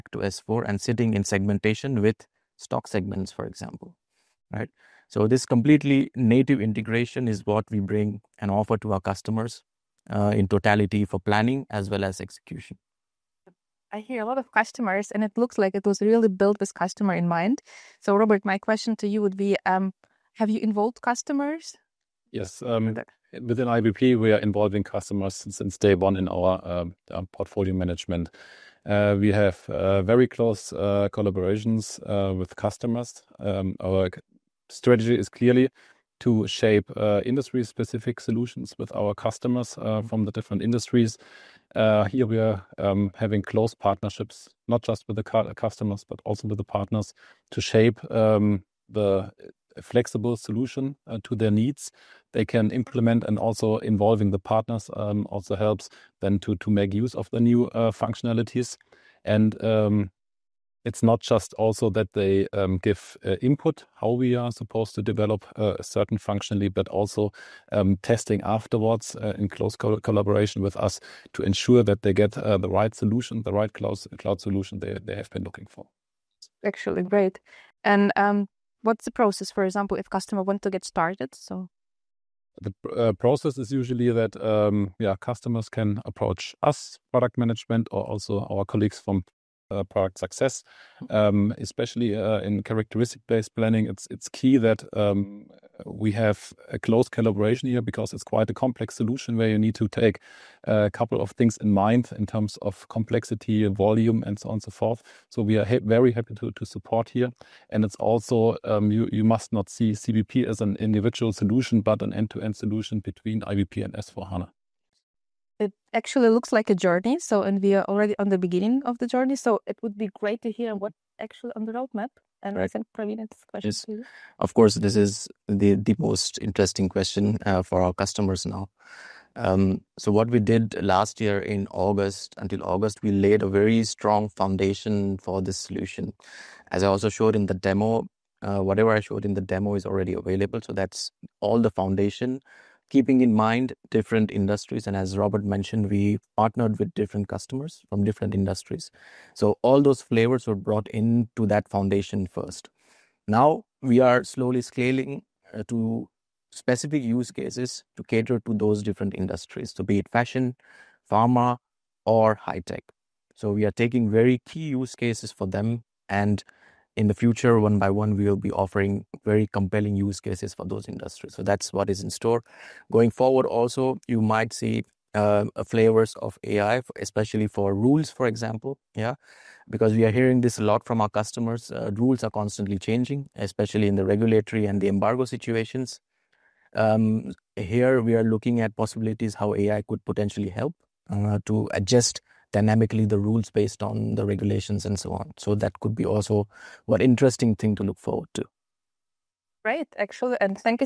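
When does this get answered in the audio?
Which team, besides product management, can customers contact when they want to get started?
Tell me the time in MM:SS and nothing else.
01:29.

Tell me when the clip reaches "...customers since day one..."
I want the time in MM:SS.
00:24.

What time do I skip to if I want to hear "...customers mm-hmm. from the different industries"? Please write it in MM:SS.
00:39.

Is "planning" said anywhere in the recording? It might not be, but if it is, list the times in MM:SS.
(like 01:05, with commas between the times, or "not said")
00:11, 01:33.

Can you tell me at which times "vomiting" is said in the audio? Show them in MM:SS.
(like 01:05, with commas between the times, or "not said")
not said.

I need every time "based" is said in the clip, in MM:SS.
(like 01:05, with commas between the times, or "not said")
01:32, 03:13.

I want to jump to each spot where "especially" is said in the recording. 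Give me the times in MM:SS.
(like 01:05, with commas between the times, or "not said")
01:31, 02:56, 03:03.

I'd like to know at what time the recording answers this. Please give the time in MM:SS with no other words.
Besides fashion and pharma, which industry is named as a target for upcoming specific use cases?
02:42.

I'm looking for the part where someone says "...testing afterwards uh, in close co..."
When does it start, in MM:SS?
01:08.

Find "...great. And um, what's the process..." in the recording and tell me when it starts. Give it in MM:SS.
01:17.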